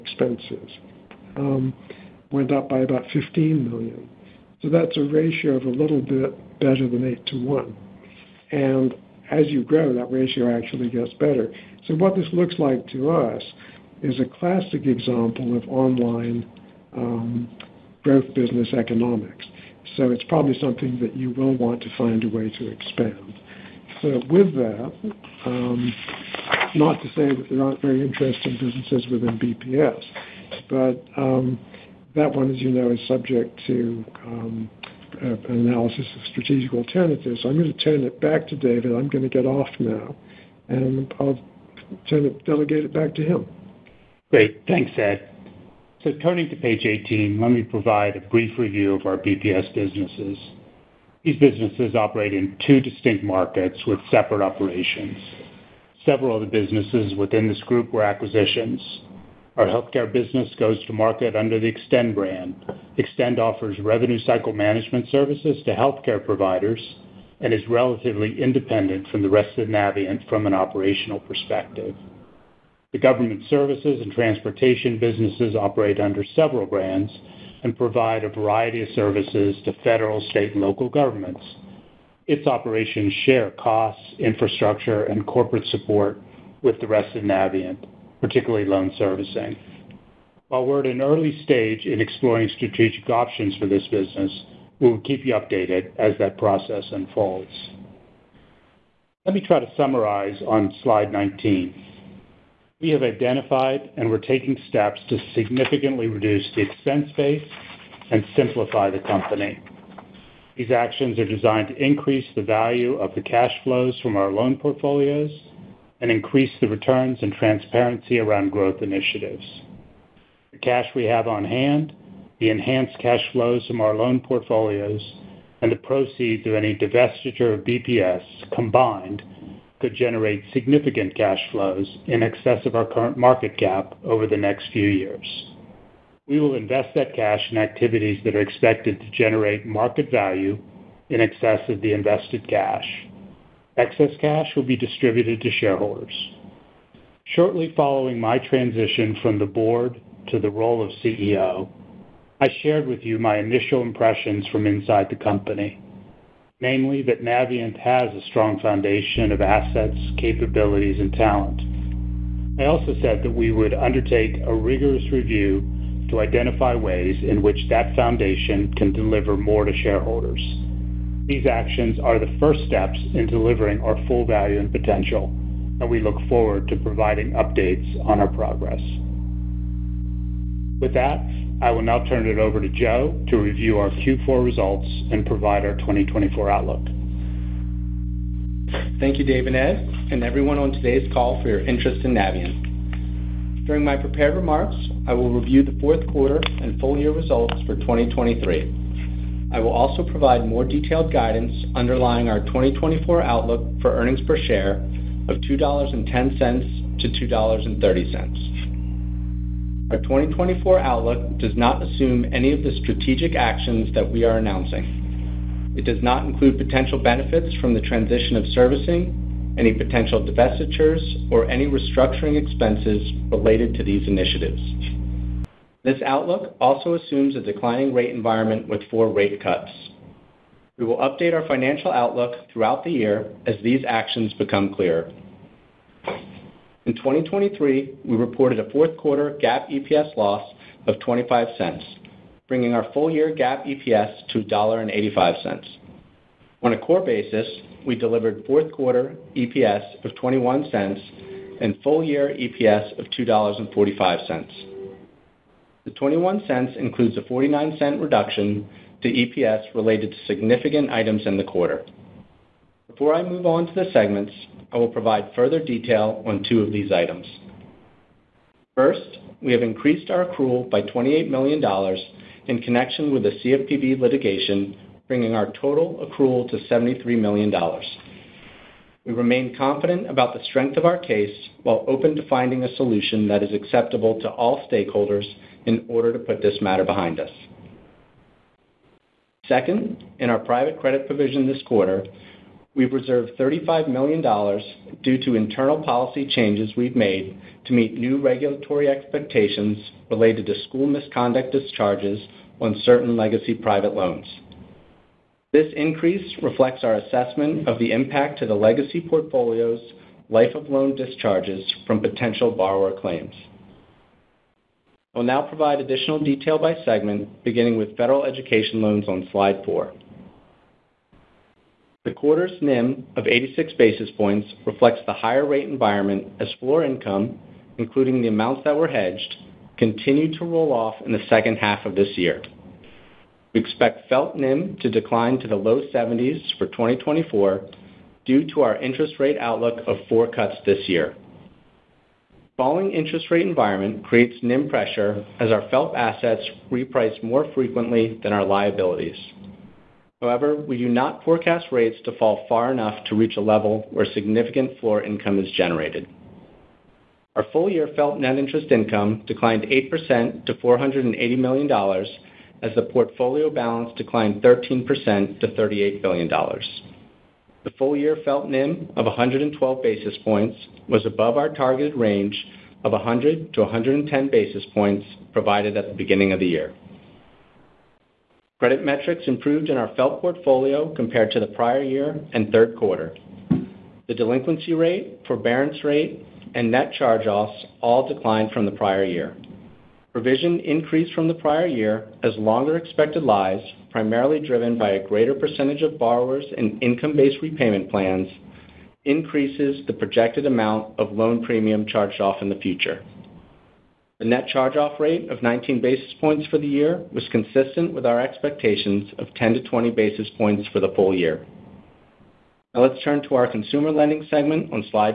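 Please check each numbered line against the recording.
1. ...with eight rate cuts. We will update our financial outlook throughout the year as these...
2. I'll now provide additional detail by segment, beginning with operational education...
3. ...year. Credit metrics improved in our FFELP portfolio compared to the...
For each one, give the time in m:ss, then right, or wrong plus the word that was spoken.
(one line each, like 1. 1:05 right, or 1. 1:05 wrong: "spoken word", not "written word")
1. 3:48 wrong: "four", not "eight"
2. 5:15 wrong: "federal", not "operational"
3. 6:16 right.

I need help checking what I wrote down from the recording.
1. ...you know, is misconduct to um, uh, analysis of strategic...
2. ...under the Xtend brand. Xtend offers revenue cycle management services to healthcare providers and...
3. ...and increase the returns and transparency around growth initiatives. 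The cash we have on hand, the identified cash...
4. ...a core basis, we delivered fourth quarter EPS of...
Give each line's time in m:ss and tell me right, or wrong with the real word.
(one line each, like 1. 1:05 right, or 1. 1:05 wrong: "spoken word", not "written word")
1. 0:32 wrong: "subject", not "misconduct"
2. 1:01 right
3. 1:56 wrong: "enhanced", not "identified"
4. 4:06 right.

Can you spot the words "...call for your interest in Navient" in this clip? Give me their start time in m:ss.
3:11.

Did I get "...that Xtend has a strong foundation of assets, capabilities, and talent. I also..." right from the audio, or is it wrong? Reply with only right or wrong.
wrong.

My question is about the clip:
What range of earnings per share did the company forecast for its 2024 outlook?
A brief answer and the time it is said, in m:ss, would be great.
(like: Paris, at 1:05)
$2.10-$2.30, at 3:25.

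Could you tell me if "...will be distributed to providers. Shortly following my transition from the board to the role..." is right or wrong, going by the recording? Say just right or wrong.
wrong.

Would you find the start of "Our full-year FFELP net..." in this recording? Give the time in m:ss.
5:57.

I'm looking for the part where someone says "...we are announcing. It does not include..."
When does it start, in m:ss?
3:34.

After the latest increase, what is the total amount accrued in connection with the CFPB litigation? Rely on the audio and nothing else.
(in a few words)
$73 million.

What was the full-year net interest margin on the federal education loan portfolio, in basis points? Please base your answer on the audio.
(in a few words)
112 basis points.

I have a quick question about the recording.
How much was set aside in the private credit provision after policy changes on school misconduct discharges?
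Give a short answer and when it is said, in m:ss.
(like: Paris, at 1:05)
$35 million, at 4:53.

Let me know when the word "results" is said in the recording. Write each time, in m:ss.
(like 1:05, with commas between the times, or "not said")
3:04, 3:17.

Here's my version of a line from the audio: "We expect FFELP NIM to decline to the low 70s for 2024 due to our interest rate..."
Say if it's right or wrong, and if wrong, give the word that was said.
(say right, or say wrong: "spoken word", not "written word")
right.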